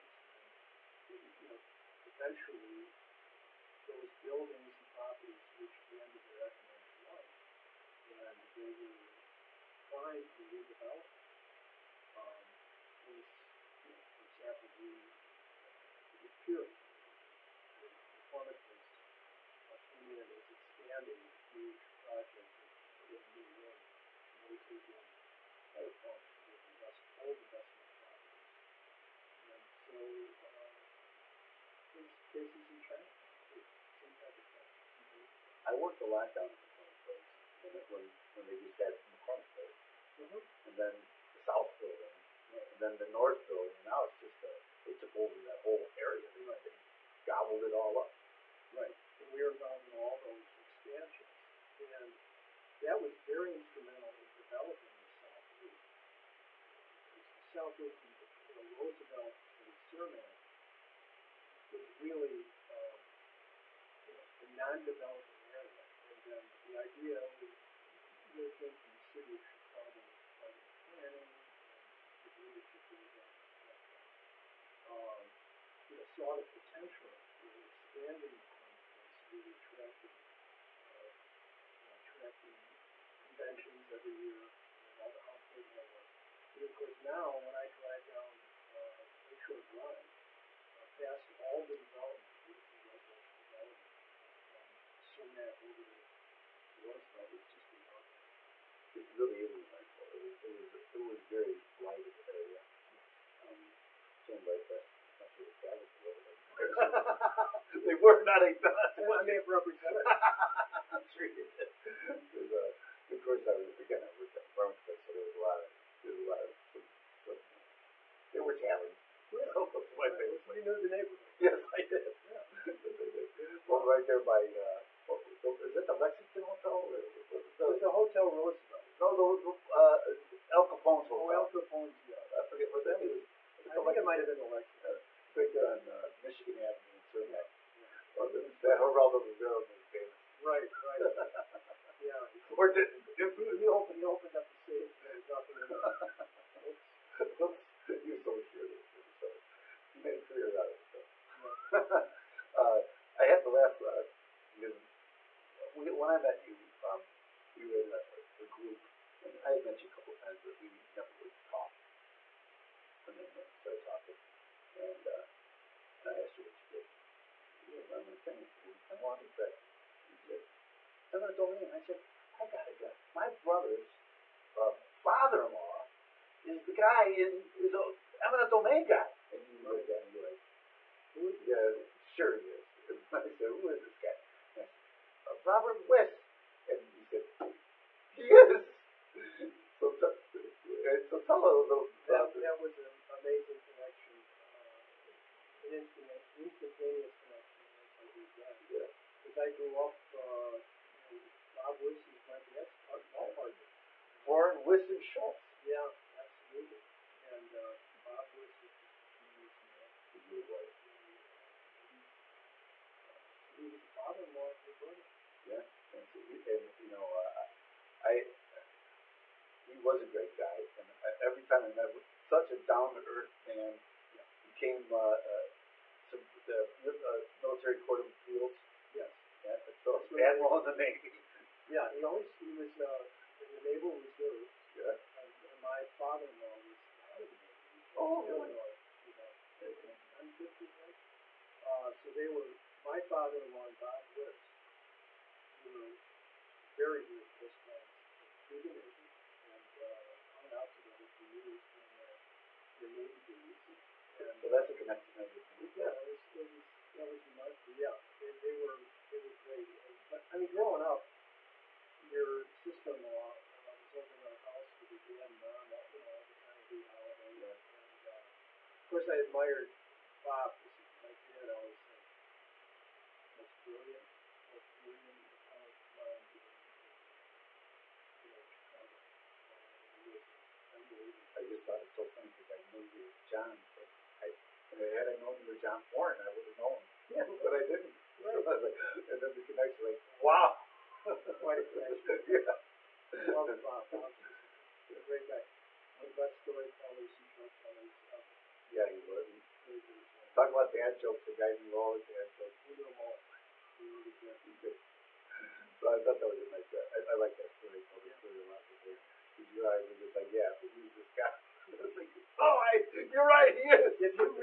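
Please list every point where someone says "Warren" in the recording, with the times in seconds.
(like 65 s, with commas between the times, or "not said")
204 s.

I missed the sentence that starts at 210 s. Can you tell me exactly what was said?
Uh, he, uh, so he was a father-in-law of brother.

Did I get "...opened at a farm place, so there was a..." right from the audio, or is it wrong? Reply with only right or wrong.
wrong.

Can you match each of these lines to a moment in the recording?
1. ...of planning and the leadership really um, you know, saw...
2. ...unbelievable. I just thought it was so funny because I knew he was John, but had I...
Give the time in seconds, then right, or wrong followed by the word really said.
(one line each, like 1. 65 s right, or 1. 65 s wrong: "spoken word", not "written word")
1. 70 s right
2. 280 s right.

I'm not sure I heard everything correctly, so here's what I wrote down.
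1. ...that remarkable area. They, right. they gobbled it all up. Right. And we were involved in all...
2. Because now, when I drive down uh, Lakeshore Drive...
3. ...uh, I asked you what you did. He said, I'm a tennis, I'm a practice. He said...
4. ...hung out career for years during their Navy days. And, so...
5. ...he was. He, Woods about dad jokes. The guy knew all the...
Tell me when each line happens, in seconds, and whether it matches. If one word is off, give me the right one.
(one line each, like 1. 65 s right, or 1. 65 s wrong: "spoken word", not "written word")
1. 45 s wrong: "whole", not "remarkable"
2. 86 s right
3. 165 s right
4. 250 s wrong: "together", not "career"
5. 298 s wrong: "Talk", not "Woods".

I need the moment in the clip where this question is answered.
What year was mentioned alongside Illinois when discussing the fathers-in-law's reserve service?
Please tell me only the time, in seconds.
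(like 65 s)
240 s.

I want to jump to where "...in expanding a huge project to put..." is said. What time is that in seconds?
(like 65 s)
20 s.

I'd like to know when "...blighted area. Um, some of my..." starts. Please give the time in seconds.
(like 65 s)
101 s.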